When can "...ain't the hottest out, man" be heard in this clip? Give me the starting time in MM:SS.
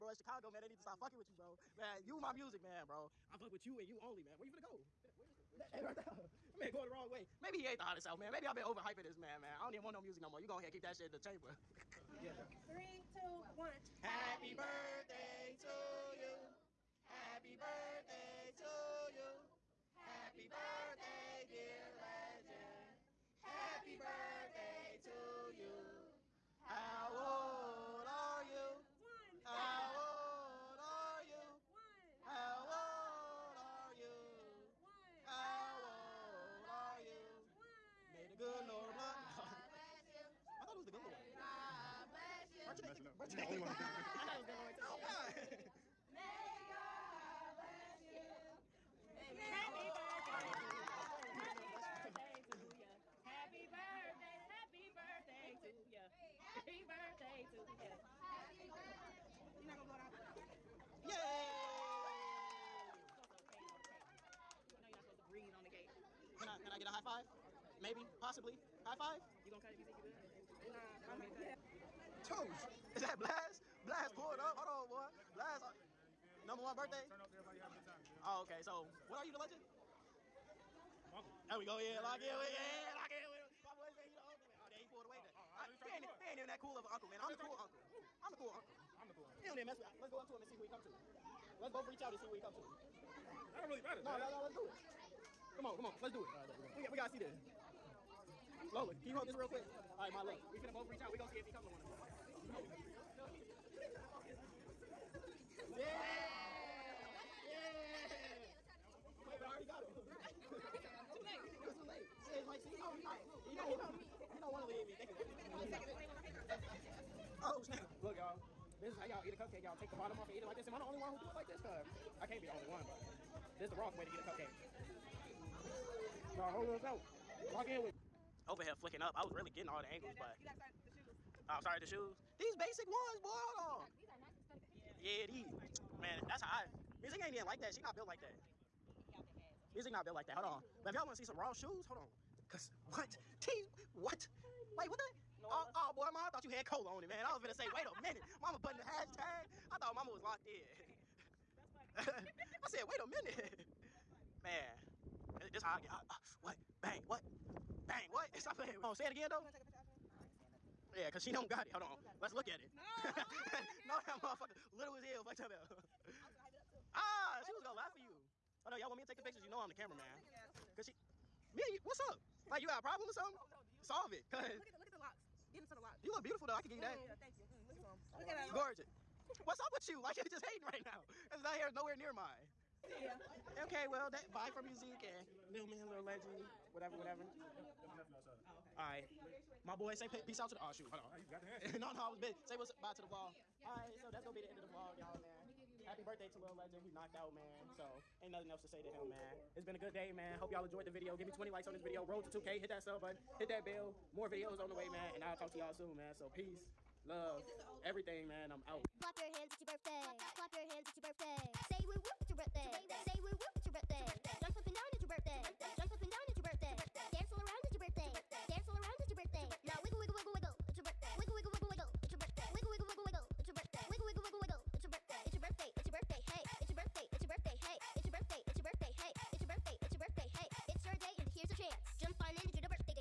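00:07.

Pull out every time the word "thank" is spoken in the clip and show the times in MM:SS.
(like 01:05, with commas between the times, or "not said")
01:54, 02:57.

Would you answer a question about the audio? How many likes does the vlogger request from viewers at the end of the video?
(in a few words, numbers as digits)
20.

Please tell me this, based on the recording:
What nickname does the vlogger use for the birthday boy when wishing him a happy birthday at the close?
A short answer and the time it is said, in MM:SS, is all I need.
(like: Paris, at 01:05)
Lil Legend, at 03:16.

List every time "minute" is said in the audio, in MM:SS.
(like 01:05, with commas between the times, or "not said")
02:28, 02:33.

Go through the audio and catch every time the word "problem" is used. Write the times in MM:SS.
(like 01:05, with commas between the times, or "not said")
02:52.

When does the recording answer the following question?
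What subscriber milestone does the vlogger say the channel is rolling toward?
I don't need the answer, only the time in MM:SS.
03:22.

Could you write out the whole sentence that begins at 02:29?
I thought mama was locked in.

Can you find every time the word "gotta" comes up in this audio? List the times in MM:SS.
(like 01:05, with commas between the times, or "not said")
01:36, 02:10.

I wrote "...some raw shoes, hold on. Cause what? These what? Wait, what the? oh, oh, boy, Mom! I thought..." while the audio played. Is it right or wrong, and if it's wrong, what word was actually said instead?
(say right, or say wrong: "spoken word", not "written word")
right.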